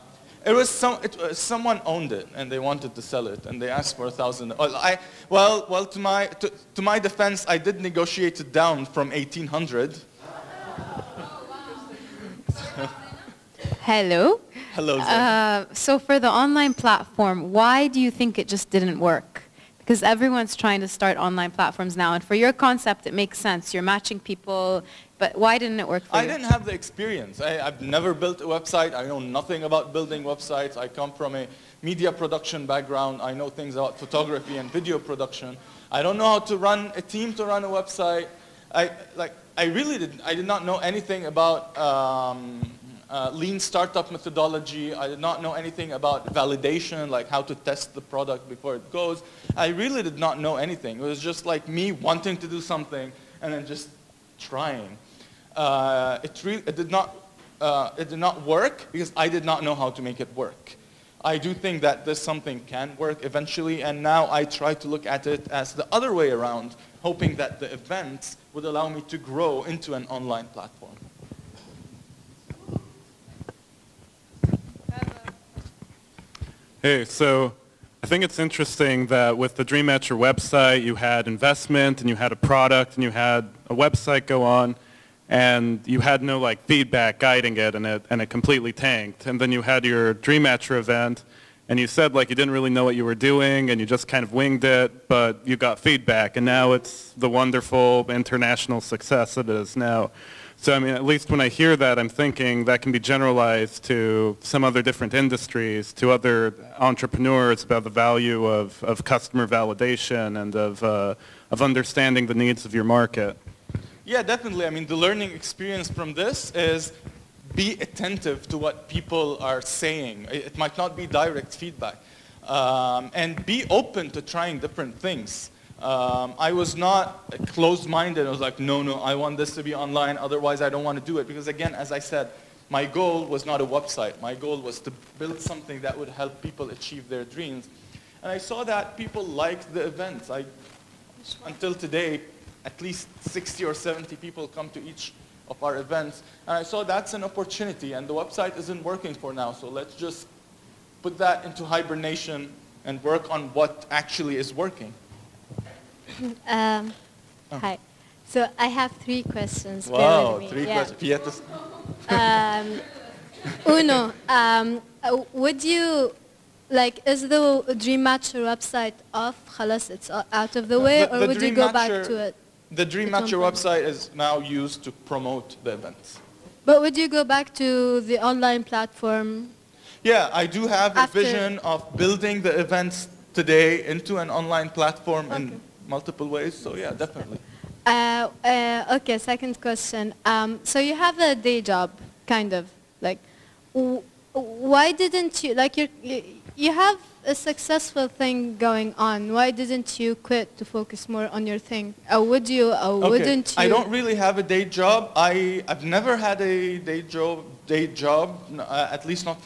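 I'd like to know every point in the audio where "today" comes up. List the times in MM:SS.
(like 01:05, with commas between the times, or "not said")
02:21, 03:03.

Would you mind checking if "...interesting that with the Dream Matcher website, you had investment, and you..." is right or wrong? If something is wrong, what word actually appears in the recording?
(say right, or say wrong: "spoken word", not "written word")
right.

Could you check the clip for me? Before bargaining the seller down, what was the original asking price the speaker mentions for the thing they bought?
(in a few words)
1800.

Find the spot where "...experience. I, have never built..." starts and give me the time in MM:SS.
00:26.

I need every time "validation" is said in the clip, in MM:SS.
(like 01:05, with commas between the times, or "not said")
00:46, 01:49.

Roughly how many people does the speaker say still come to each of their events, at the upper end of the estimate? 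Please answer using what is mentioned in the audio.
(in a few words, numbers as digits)
70.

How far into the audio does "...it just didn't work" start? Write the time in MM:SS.
00:18.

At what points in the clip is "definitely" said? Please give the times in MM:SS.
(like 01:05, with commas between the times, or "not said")
01:54, 03:06.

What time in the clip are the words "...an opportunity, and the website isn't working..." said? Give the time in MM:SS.
02:27.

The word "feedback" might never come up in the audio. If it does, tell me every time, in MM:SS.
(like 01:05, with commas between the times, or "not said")
01:26, 01:35, 02:01.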